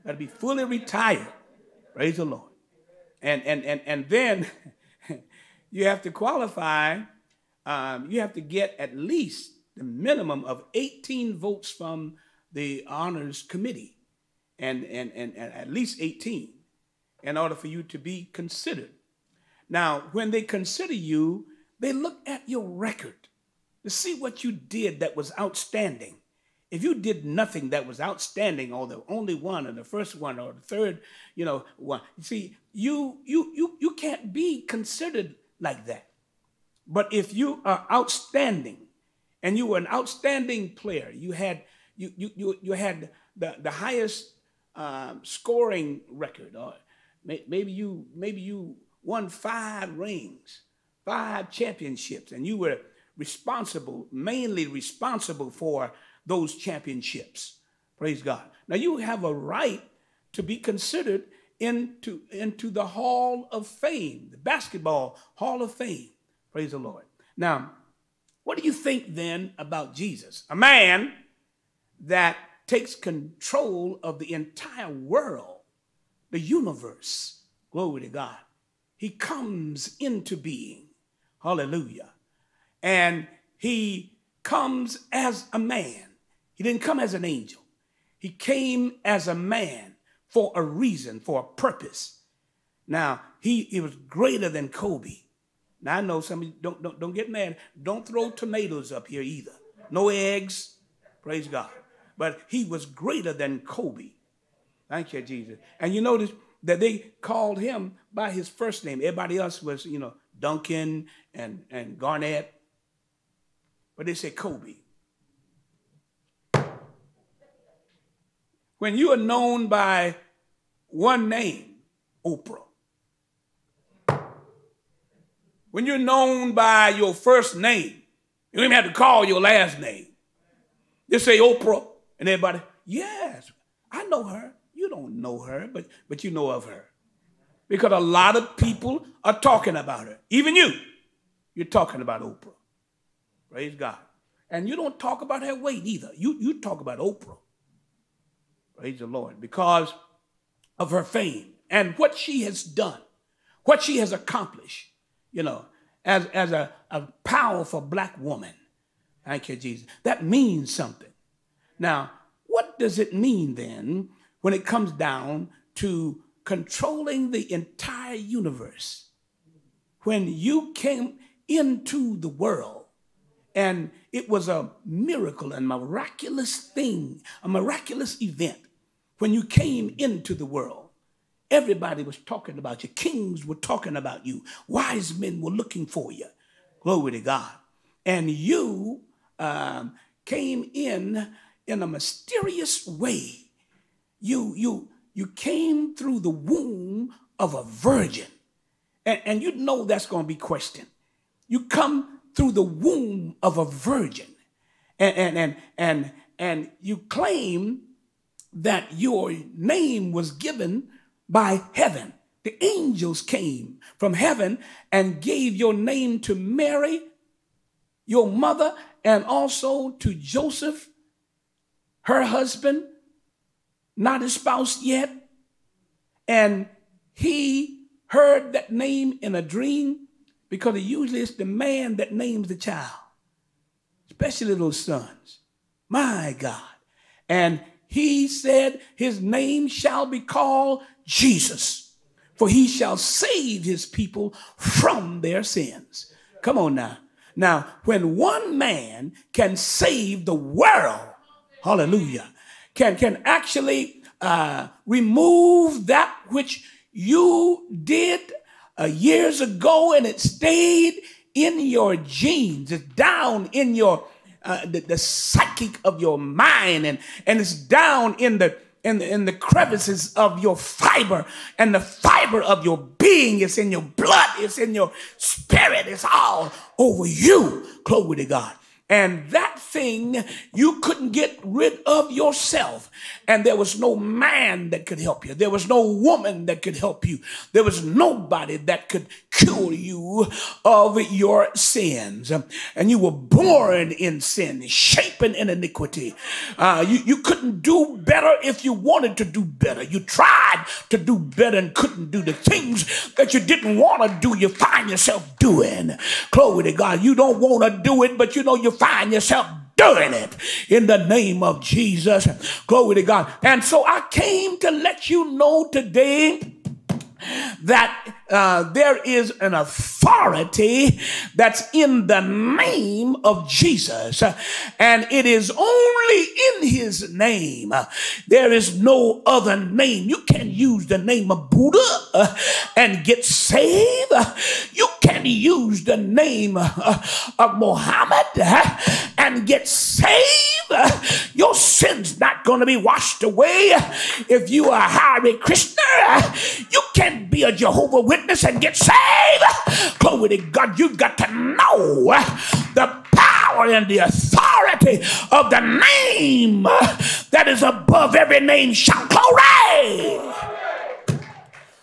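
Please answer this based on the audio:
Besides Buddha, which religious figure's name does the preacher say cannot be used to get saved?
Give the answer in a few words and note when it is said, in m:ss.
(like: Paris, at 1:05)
Mohammed, at 5:37.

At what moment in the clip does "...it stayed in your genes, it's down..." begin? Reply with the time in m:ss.
4:20.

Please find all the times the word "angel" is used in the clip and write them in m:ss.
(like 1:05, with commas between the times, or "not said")
1:27, 3:32.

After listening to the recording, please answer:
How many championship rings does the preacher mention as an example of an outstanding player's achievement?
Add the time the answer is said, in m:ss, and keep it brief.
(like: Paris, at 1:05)
5, at 0:49.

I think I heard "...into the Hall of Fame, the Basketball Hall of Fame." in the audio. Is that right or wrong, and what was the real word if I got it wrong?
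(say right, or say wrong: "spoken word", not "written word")
right.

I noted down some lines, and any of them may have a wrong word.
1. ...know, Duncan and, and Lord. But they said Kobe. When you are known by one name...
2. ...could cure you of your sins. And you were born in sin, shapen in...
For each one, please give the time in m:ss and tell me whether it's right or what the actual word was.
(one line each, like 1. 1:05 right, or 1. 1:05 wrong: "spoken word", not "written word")
1. 1:49 wrong: "Garnett", not "Lord"
2. 4:48 right.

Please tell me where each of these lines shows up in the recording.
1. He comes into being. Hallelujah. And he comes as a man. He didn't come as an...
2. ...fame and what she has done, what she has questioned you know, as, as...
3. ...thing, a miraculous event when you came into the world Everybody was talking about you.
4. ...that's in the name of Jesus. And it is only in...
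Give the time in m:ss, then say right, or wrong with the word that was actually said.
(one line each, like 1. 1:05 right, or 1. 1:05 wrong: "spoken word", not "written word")
1. 1:18 right
2. 2:31 wrong: "accomplished", not "questioned"
3. 2:56 right
4. 5:21 right.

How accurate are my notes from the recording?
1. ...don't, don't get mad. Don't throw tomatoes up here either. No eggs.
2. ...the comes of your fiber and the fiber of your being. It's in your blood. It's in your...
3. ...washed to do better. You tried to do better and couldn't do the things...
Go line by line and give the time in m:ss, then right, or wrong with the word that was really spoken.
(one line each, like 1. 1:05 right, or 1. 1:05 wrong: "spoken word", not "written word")
1. 1:36 right
2. 4:29 wrong: "crevices", not "comes"
3. 4:58 wrong: "wanted", not "washed".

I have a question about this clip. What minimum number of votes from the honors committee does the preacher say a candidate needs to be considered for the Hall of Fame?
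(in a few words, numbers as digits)
18.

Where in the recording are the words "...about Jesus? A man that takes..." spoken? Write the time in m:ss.
1:09.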